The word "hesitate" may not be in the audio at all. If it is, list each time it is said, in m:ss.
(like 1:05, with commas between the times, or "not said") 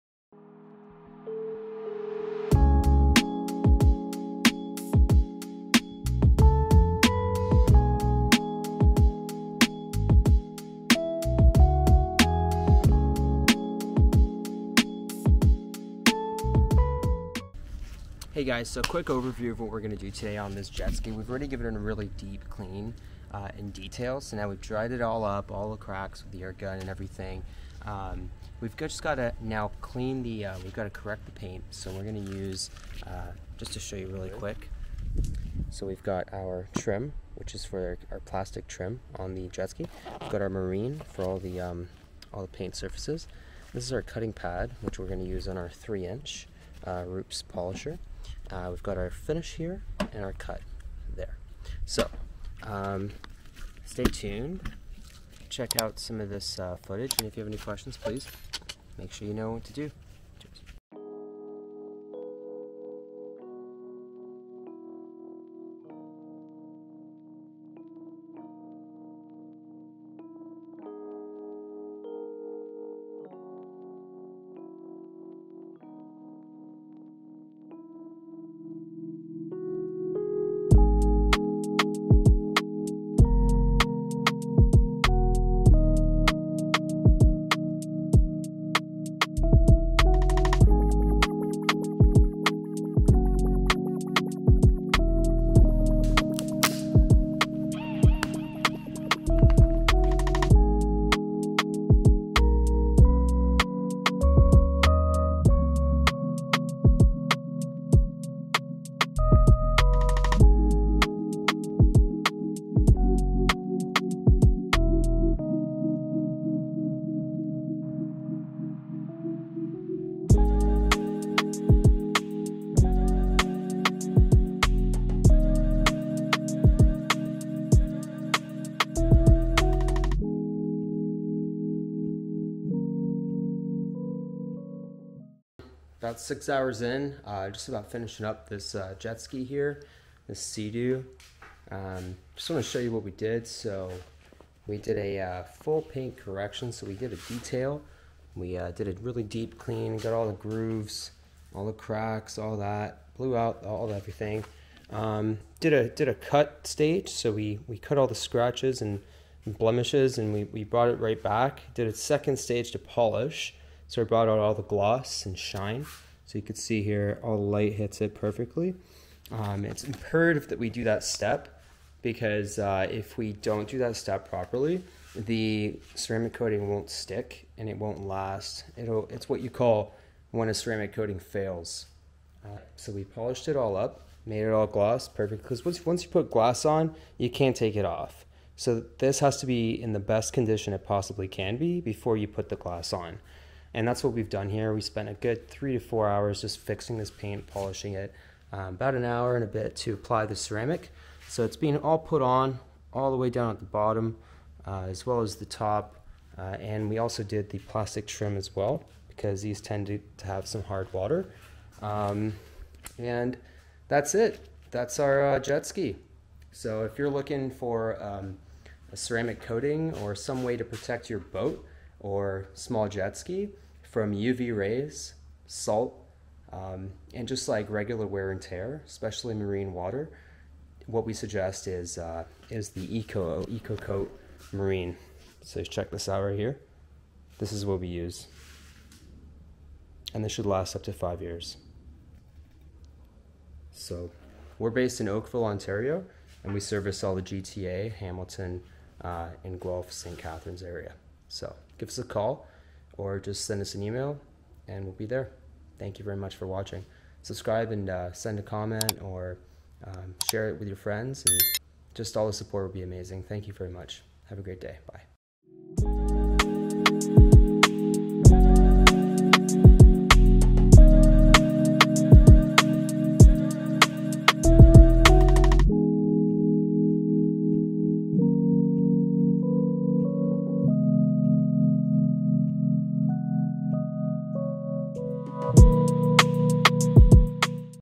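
not said.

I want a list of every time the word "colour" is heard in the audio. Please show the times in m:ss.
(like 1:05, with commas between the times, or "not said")
not said.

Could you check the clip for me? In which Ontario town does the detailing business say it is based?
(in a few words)
Oakville.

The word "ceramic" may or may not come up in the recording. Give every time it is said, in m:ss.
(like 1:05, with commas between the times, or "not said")
2:55, 3:00, 3:20, 3:38.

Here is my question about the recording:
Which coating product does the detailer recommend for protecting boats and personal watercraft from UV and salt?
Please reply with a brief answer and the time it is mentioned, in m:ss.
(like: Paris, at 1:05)
Eco Coat Marine, at 3:53.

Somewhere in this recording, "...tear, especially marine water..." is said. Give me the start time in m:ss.
3:48.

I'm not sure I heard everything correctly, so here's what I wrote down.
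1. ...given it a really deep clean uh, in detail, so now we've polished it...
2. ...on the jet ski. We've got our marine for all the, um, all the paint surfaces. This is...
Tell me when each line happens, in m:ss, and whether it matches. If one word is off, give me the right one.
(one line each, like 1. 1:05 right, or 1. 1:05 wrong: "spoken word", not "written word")
1. 0:21 wrong: "dried", not "polished"
2. 0:39 right.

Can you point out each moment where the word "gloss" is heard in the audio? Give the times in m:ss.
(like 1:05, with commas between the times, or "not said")
2:44, 3:04.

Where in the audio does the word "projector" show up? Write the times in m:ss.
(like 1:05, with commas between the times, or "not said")
not said.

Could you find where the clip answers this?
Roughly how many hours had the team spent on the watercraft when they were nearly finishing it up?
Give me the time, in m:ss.
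2:16.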